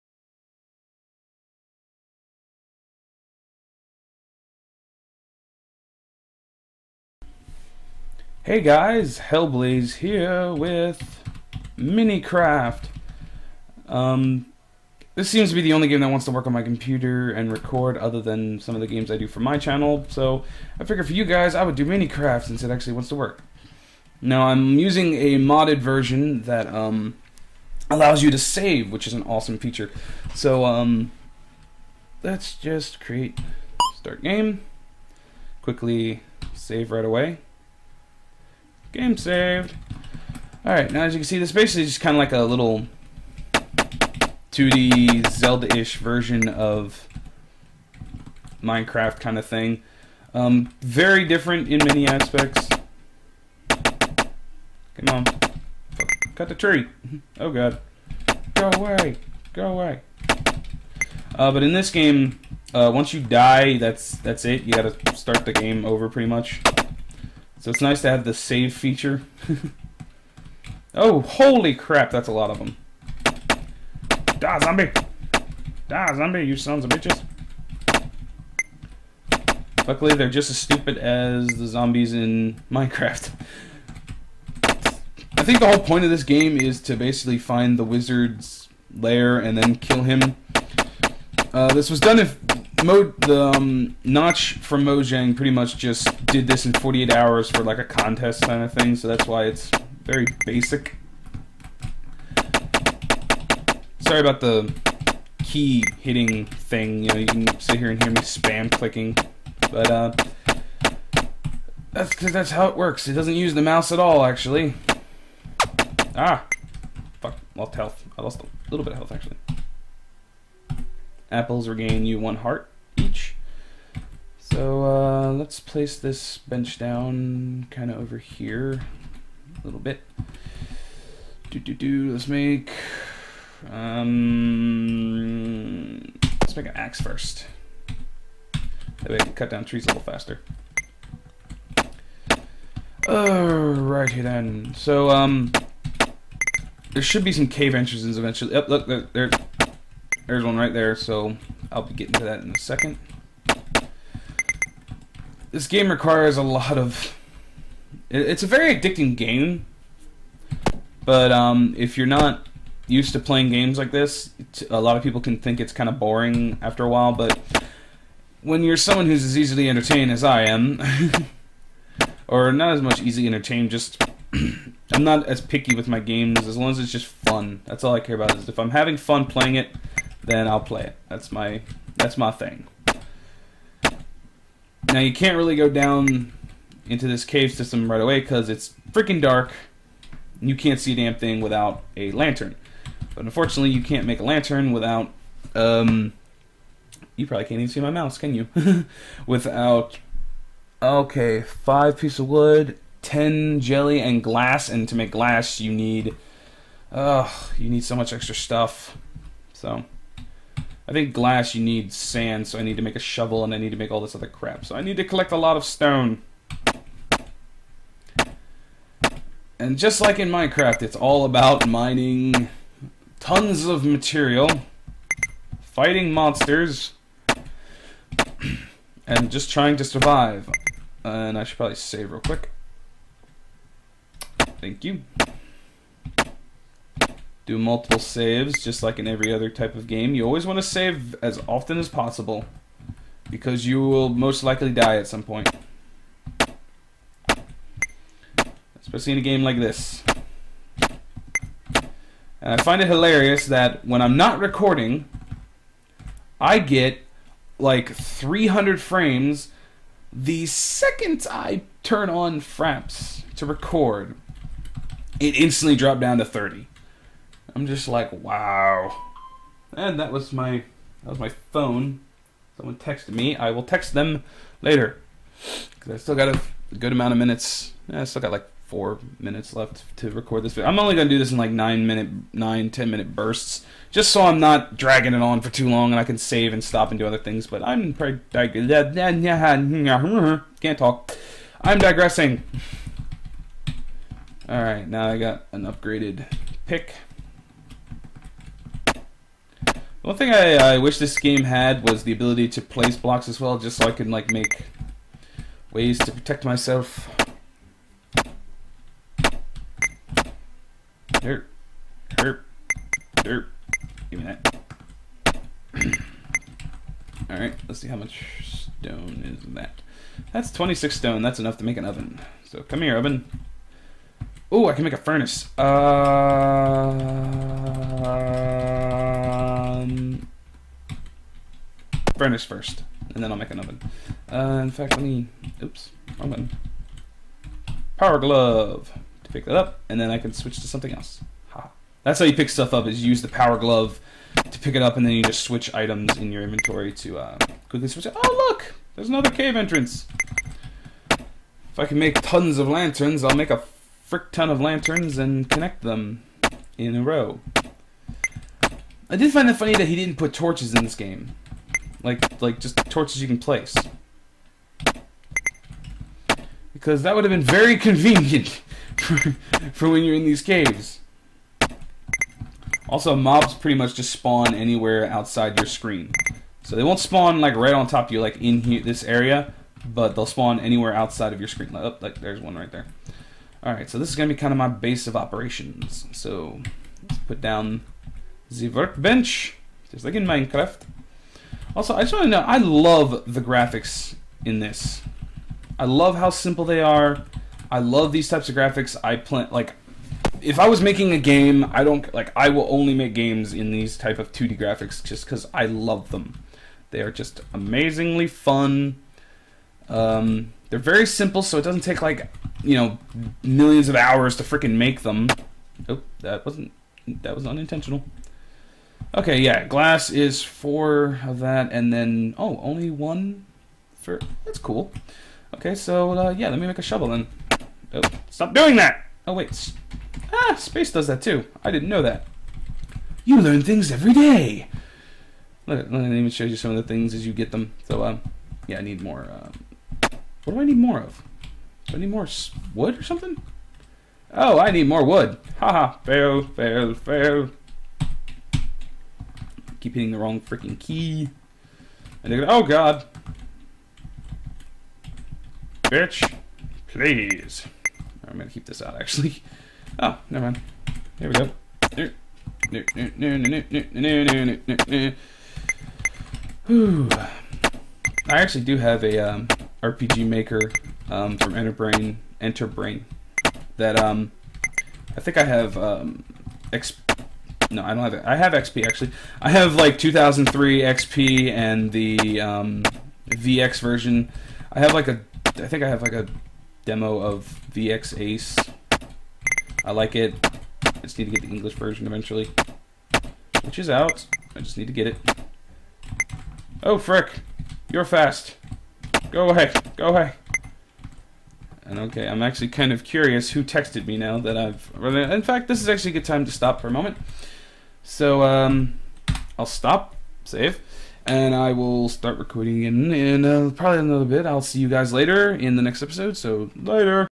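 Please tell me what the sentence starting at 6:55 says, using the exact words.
Oh, that wasn't that was unintentional.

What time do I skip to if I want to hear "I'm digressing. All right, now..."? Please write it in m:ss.
4:51.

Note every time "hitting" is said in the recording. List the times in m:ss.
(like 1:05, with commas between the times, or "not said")
1:45, 7:29.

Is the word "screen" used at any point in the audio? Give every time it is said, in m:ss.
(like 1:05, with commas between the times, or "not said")
6:15, 6:21.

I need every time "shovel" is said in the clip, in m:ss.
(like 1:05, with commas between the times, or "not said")
3:32, 7:06.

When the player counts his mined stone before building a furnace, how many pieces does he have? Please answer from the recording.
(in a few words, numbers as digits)
26.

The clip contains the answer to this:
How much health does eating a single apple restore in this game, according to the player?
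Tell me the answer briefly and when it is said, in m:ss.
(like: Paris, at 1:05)
1 heart, at 2:02.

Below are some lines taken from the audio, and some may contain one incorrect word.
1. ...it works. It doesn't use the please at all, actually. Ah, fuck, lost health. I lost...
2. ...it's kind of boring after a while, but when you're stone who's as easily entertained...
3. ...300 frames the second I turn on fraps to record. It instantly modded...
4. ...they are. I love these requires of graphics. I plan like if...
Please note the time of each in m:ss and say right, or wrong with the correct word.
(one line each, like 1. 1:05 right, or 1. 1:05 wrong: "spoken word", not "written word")
1. 1:52 wrong: "mouse", not "please"
2. 2:45 wrong: "someone", not "stone"
3. 4:17 wrong: "dropped", not "modded"
4. 6:36 wrong: "types", not "requires".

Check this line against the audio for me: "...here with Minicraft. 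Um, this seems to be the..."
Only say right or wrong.
right.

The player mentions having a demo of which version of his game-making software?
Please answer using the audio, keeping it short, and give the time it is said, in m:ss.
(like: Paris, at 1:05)
VX Ace, at 8:07.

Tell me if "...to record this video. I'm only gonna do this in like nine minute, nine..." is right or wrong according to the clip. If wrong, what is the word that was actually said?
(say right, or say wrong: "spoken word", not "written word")
right.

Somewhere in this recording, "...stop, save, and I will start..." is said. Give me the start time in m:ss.
8:29.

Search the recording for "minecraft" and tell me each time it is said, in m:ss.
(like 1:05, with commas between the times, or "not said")
0:48, 1:22, 3:40, 6:30.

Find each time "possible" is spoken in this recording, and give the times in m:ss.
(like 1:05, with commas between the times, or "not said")
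4:01.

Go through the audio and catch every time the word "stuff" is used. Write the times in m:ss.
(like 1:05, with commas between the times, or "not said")
3:28, 5:42.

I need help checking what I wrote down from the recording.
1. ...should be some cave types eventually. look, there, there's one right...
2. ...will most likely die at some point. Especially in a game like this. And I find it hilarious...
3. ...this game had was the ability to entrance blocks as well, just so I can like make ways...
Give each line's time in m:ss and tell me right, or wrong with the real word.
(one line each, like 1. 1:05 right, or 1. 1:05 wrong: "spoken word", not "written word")
1. 2:27 wrong: "entrances", not "types"
2. 4:03 right
3. 5:00 wrong: "place", not "entrance".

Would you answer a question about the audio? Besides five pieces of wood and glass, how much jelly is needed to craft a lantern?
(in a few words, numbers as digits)
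10.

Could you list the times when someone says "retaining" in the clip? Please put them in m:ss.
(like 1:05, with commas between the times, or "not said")
not said.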